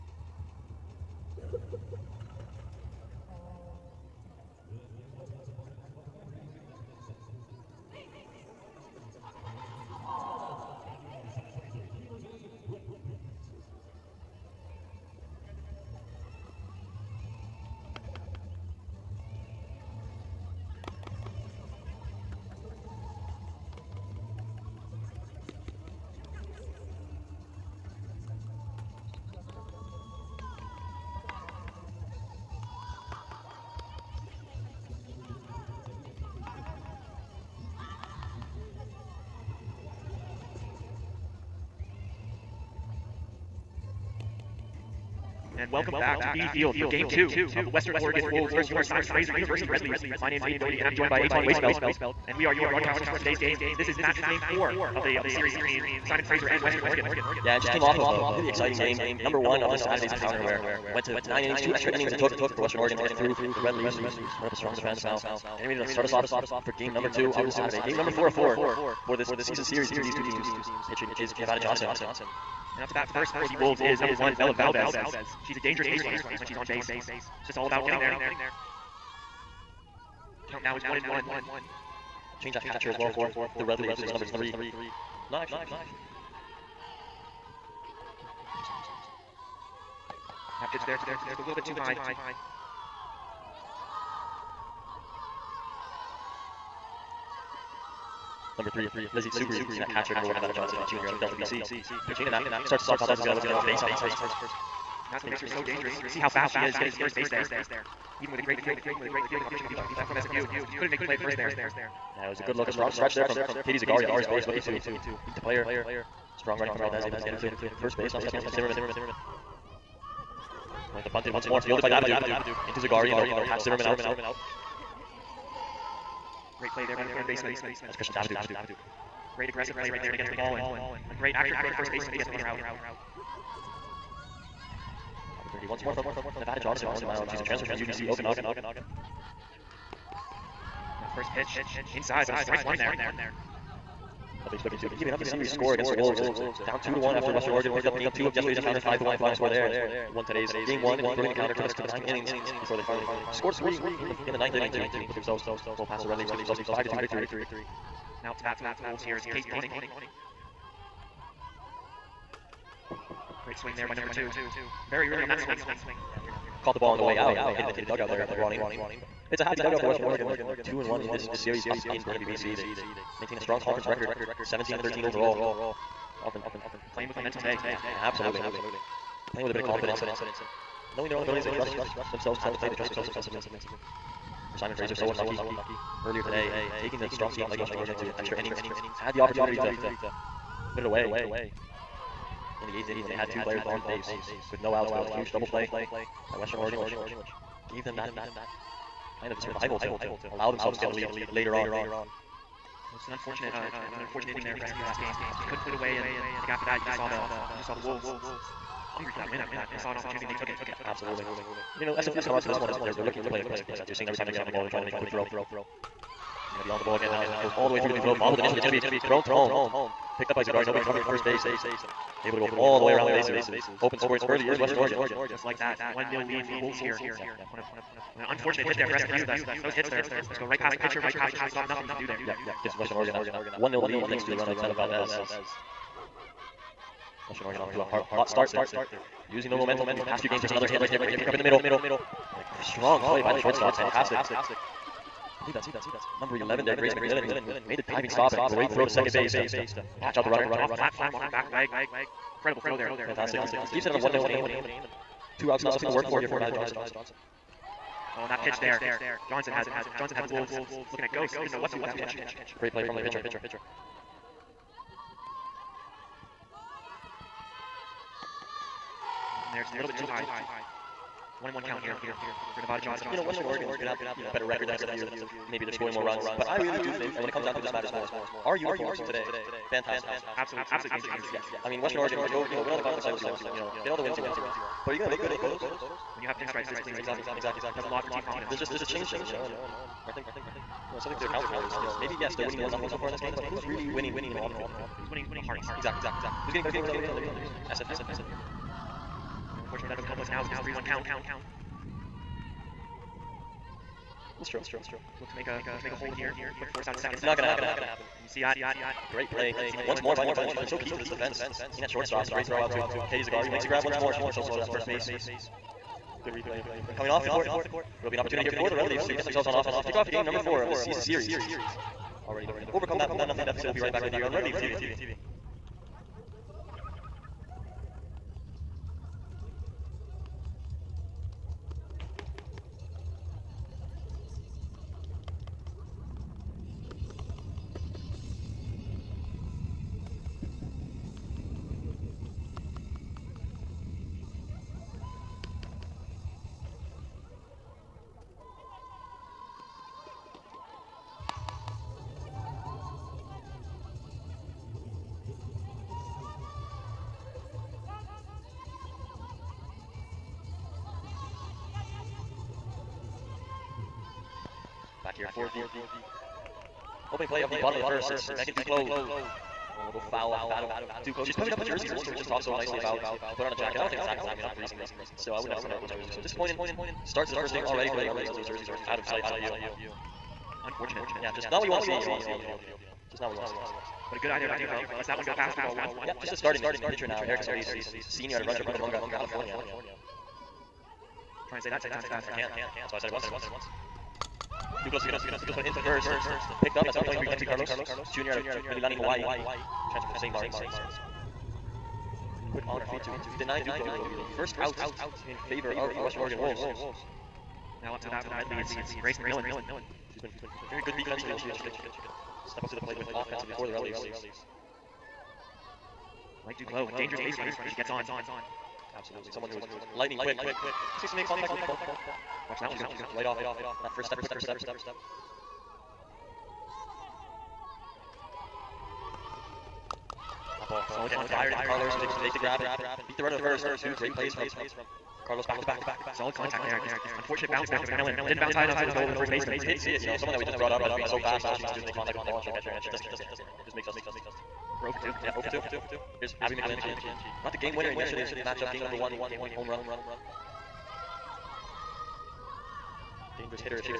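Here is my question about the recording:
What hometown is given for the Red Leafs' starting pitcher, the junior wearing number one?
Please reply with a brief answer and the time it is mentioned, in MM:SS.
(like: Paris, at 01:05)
Delta, BC, at 01:41.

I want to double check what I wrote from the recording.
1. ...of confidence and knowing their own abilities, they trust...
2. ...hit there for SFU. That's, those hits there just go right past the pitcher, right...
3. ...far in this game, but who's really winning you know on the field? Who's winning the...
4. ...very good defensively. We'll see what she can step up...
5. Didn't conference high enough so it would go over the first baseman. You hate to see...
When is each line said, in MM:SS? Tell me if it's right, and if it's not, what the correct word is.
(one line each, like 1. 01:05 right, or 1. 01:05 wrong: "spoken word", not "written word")
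1. 02:59 right
2. 03:48 right
3. 04:53 right
4. 06:50 right
5. 07:18 wrong: "bounce", not "conference".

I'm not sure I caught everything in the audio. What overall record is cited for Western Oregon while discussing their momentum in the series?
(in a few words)
17 and 13.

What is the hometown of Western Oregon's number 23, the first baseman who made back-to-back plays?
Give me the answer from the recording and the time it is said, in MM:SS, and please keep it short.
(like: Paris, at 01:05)
Mililani, Hawaii, at 06:38.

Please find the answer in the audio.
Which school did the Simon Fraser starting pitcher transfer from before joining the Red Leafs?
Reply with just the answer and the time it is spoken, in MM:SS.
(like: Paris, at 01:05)
UBC Okanagan, at 02:17.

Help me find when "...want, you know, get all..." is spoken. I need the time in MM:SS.
04:43.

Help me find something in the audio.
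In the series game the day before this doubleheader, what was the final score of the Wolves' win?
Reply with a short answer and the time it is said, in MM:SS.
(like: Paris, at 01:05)
5-1, at 02:28.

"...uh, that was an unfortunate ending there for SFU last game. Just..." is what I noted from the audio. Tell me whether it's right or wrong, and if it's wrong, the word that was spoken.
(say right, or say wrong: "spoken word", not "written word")
right.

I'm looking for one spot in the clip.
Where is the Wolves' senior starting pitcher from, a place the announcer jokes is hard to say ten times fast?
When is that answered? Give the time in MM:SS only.
06:28.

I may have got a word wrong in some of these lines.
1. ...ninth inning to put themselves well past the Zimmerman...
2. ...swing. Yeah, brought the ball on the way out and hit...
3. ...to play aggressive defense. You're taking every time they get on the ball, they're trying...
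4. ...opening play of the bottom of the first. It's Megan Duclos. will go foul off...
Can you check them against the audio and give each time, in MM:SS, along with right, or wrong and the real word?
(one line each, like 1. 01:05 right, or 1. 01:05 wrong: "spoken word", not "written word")
1. 02:34 wrong: "Red", not "Zimmerman"
2. 02:45 wrong: "caught", not "brought"
3. 03:33 wrong: "seeing", not "taking"
4. 06:07 right.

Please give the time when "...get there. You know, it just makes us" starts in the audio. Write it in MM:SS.
07:23.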